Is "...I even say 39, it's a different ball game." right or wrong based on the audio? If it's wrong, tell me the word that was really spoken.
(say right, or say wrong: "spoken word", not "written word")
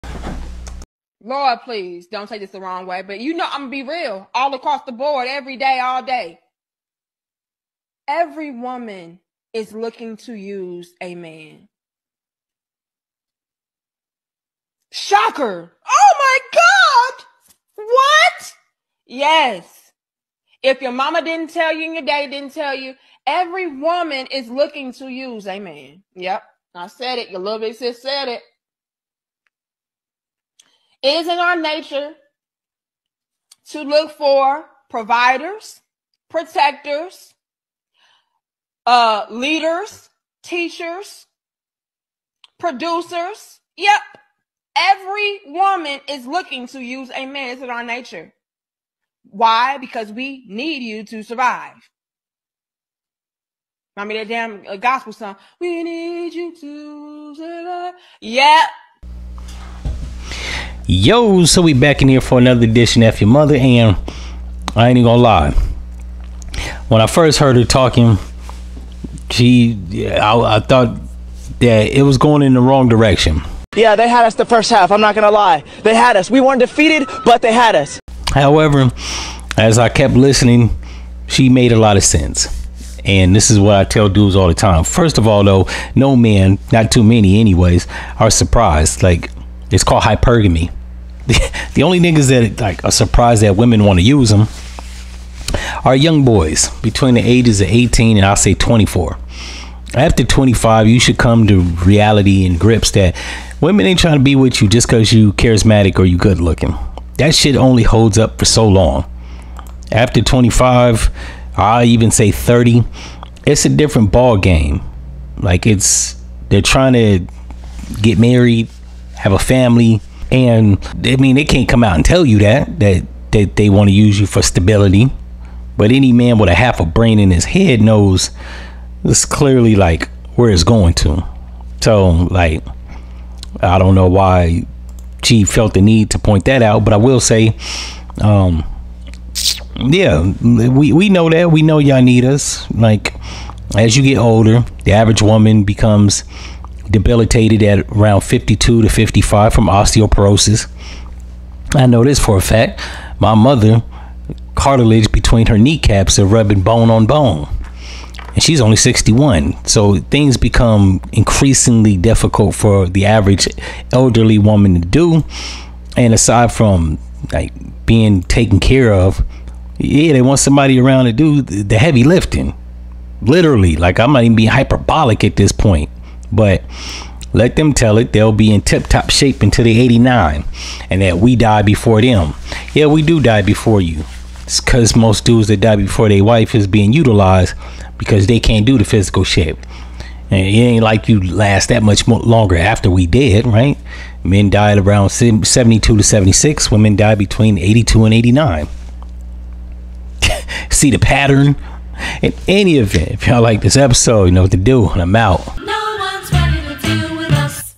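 wrong: "30", not "39".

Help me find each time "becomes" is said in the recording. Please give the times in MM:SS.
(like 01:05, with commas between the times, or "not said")
02:25, 02:40.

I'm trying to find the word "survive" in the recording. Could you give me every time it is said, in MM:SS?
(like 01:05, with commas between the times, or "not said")
00:51, 00:57.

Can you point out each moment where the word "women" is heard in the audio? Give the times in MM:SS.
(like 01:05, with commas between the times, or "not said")
01:33, 01:43, 03:16.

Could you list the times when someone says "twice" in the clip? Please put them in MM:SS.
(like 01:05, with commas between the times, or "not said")
not said.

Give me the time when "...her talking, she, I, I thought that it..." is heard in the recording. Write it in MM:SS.
01:07.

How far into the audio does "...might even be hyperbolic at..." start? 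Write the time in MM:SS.
02:54.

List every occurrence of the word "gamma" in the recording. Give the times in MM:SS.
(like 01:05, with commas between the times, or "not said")
not said.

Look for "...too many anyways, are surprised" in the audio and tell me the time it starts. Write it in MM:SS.
01:26.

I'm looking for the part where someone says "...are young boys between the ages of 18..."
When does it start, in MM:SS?
01:35.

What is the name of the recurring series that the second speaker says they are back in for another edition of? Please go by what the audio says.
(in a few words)
F-ya-Motha.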